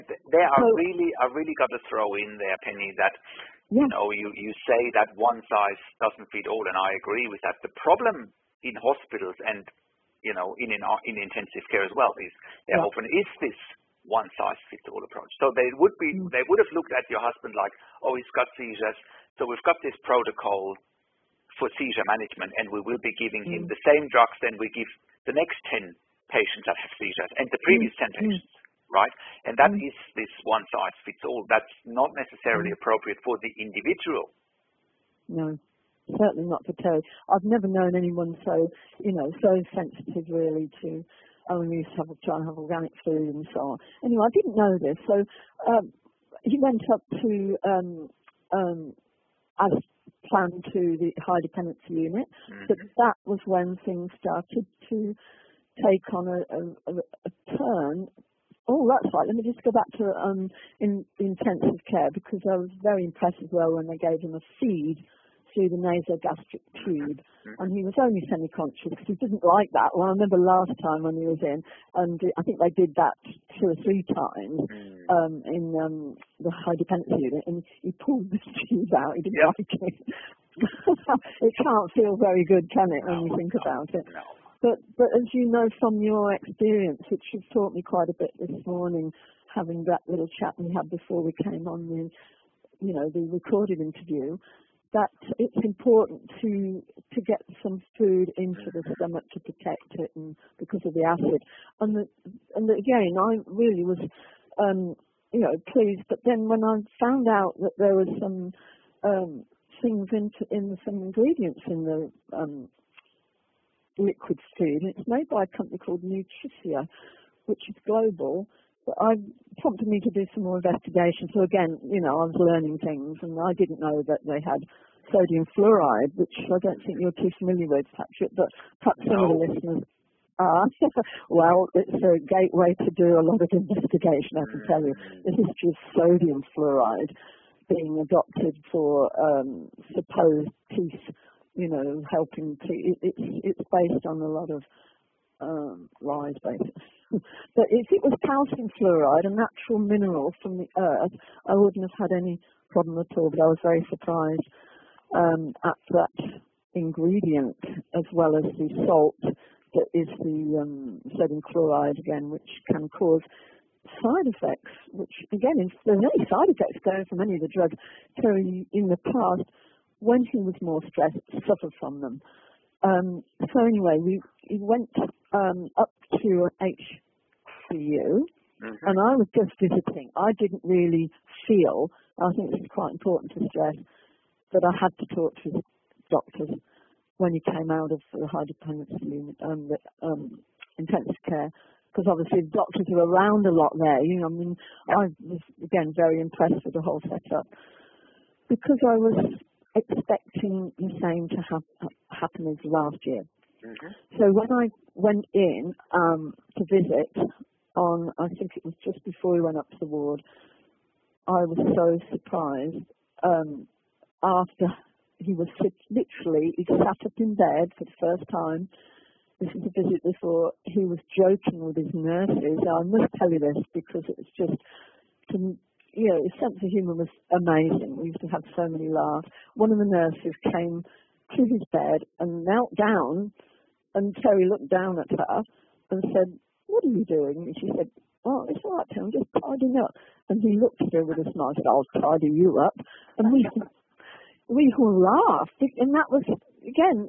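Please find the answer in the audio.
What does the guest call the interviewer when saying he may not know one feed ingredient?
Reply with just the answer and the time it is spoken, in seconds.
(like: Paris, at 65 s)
Patrik, at 127 s.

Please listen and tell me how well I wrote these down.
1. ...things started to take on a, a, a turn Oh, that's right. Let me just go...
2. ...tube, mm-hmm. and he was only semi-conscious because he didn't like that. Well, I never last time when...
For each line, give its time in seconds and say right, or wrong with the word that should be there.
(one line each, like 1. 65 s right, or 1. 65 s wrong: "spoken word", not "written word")
1. 53 s right
2. 66 s wrong: "remember", not "never".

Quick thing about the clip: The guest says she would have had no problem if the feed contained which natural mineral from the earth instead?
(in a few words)
calcium fluoride.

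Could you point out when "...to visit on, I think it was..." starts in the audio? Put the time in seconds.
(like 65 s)
206 s.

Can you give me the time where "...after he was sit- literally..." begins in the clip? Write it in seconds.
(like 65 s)
214 s.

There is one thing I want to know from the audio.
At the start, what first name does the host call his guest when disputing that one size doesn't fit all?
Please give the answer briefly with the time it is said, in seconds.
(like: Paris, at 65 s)
Penny, at 2 s.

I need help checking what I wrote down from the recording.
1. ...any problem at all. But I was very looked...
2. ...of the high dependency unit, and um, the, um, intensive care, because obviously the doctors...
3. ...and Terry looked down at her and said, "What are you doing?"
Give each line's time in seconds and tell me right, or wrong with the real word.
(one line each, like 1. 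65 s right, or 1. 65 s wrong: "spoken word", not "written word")
1. 152 s wrong: "surprised", not "looked"
2. 187 s right
3. 233 s right.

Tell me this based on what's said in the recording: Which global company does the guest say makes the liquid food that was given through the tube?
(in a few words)
Nutricia.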